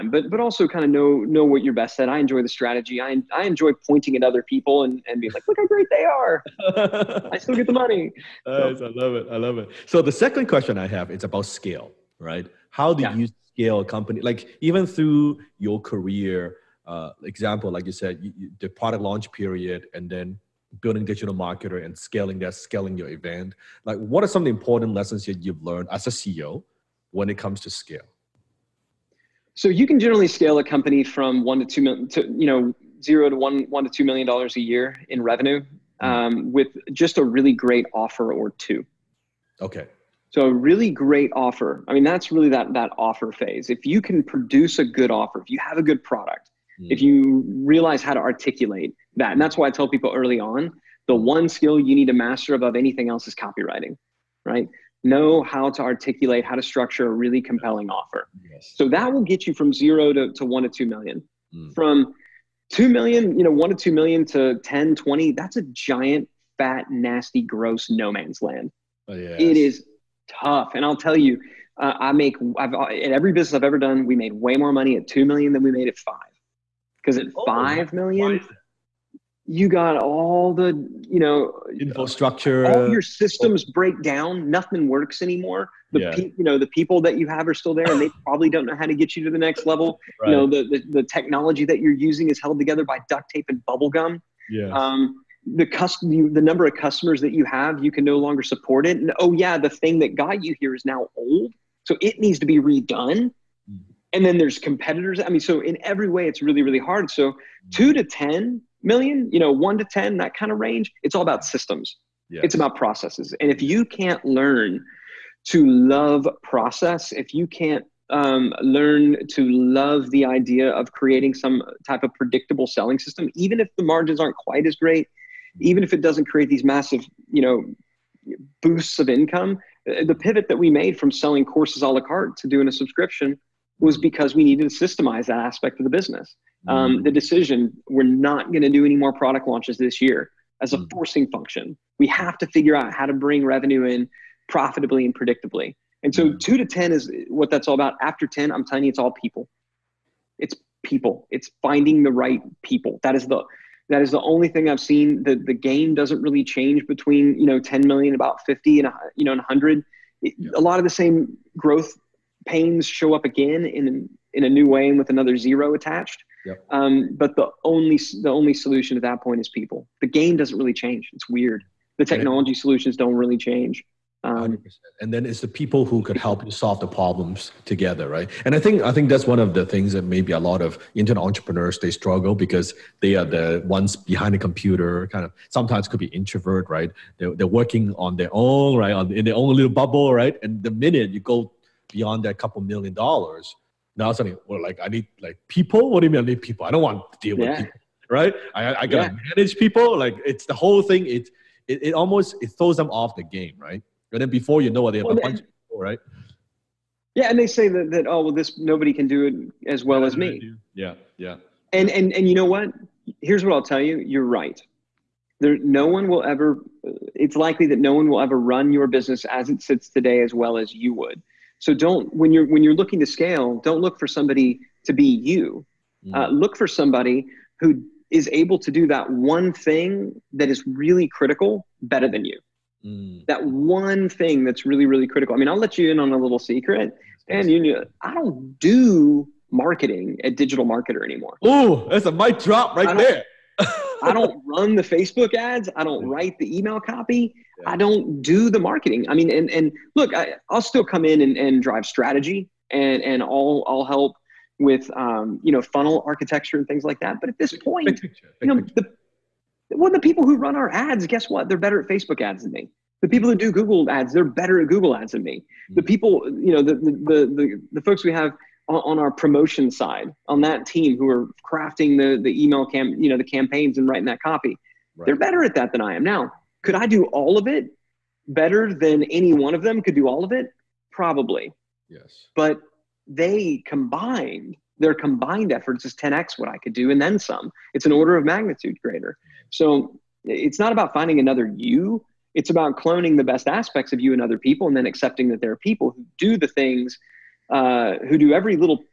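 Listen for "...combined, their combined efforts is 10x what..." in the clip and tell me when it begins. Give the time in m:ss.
4:43.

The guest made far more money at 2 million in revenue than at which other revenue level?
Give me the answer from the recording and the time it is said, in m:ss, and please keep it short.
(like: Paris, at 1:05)
5 million, at 1:15.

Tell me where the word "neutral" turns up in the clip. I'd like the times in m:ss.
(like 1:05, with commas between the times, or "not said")
not said.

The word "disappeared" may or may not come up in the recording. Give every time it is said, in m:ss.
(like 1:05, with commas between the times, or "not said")
not said.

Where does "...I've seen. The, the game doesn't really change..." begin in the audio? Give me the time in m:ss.
2:34.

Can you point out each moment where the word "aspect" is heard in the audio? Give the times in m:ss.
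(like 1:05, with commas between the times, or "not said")
2:15, 4:53.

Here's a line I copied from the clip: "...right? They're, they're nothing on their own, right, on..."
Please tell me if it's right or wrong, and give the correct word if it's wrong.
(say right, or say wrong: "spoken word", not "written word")
wrong: "working", not "nothing".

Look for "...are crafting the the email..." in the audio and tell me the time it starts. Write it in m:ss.
4:31.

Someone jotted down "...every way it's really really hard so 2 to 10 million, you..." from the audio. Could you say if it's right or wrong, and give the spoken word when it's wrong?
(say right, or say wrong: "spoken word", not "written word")
right.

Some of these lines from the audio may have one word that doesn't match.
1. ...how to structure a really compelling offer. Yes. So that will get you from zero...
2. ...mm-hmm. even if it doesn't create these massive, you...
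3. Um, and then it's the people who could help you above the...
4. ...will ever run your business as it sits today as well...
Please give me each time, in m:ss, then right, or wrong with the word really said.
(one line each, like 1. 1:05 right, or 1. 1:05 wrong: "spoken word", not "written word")
1. 0:56 right
2. 2:05 right
3. 2:54 wrong: "solve", not "above"
4. 3:38 right.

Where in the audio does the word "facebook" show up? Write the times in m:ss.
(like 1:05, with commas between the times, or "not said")
4:04, 4:21.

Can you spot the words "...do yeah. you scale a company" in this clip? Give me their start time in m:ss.
0:12.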